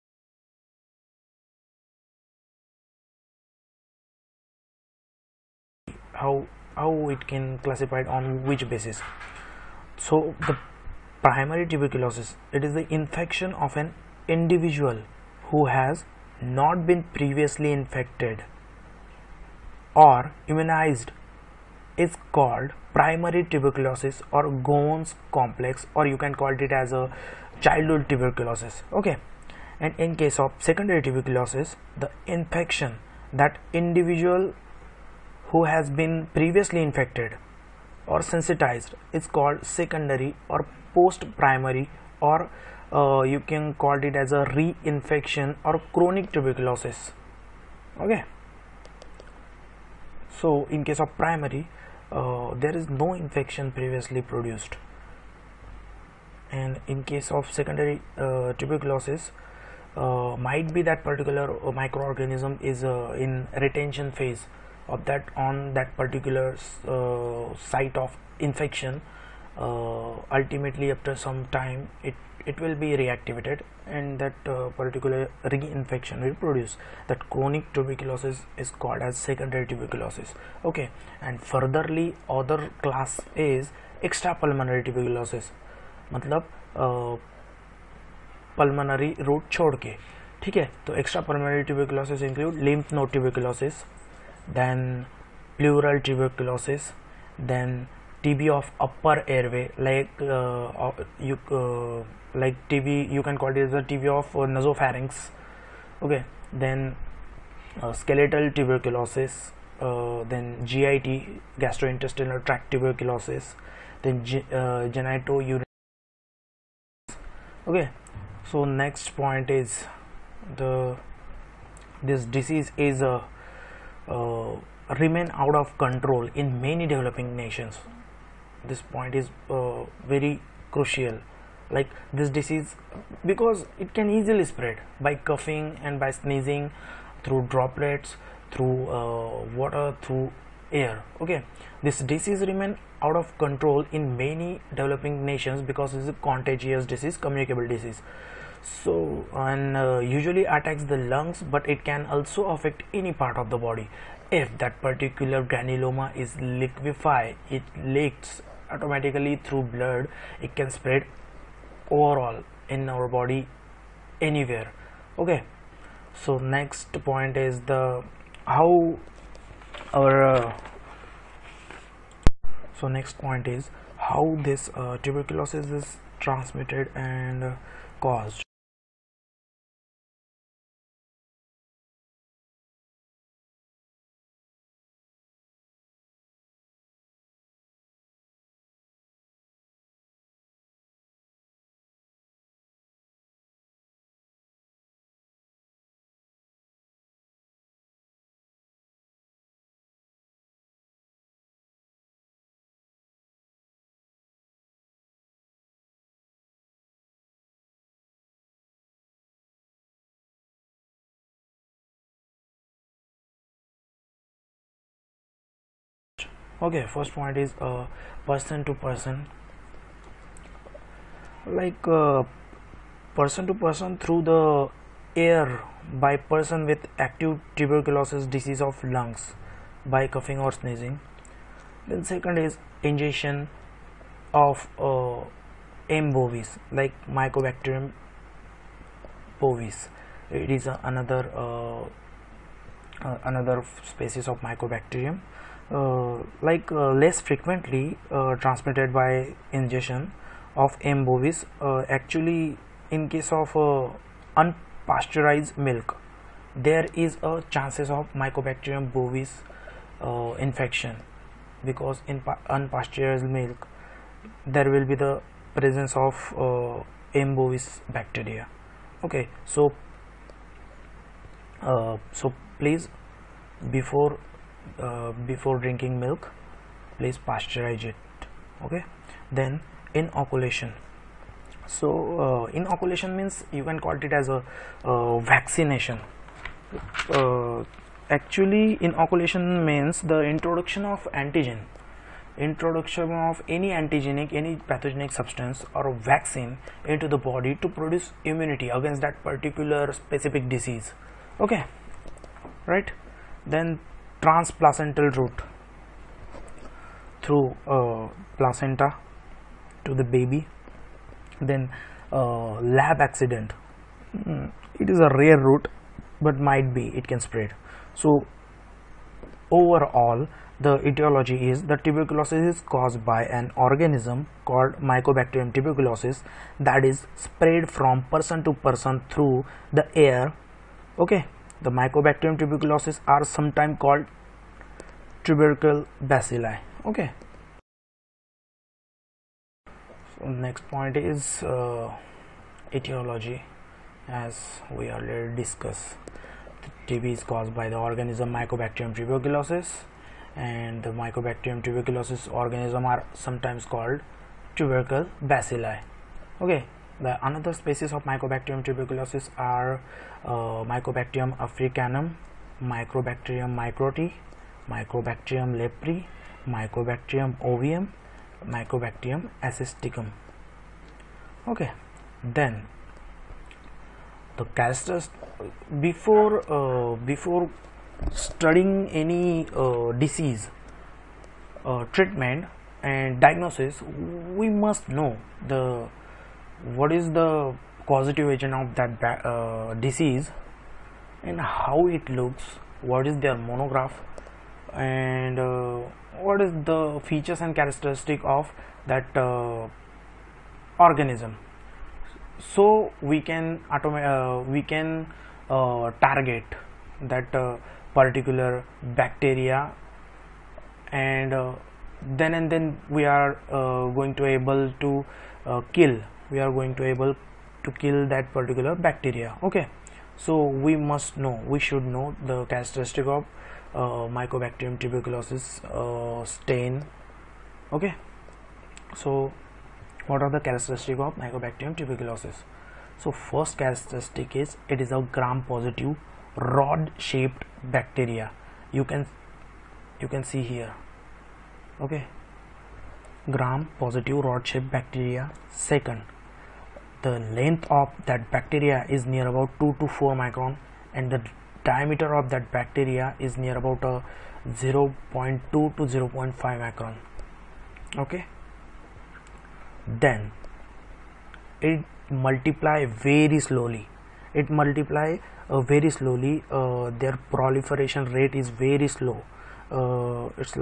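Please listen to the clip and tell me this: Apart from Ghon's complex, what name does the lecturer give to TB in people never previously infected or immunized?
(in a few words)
childhood tuberculosis.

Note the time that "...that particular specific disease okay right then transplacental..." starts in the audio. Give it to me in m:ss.
4:59.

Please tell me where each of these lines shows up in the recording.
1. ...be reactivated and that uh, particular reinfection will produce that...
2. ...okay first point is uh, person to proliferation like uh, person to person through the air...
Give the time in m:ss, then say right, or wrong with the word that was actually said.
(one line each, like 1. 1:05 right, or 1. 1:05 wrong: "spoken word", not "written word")
1. 1:12 right
2. 3:36 wrong: "person", not "proliferation".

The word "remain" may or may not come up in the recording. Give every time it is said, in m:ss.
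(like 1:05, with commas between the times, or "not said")
2:04, 2:22.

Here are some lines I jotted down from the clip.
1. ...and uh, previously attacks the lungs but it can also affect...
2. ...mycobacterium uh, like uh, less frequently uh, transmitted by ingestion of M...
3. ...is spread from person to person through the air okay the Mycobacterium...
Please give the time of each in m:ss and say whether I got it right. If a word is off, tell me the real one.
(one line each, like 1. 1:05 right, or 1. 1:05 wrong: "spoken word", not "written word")
1. 2:29 wrong: "usually", not "previously"
2. 4:04 right
3. 5:26 right.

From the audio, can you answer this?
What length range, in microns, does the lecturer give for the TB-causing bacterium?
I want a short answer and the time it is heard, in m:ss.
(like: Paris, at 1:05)
2 to 4 microns, at 7:29.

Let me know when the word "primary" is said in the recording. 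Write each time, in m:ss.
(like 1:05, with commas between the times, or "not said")
0:11, 0:22, 0:41, 0:51.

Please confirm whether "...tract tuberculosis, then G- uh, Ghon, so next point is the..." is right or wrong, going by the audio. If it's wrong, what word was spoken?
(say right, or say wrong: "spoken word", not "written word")
wrong: "Okay", not "Ghon".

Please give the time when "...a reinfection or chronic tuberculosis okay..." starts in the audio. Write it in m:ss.
0:44.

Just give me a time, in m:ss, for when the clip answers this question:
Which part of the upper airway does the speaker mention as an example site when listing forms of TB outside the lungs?
1:44.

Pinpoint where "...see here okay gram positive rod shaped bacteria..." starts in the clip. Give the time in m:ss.
7:20.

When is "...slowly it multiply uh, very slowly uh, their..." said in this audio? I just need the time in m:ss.
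7:43.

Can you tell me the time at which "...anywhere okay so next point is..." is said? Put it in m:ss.
2:44.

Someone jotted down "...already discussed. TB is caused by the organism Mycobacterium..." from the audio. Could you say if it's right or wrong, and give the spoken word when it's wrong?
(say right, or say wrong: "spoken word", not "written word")
right.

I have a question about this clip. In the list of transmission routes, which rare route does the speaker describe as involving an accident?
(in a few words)
lab accident.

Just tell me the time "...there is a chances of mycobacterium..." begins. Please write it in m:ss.
4:16.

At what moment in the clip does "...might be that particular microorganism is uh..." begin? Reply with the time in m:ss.
1:00.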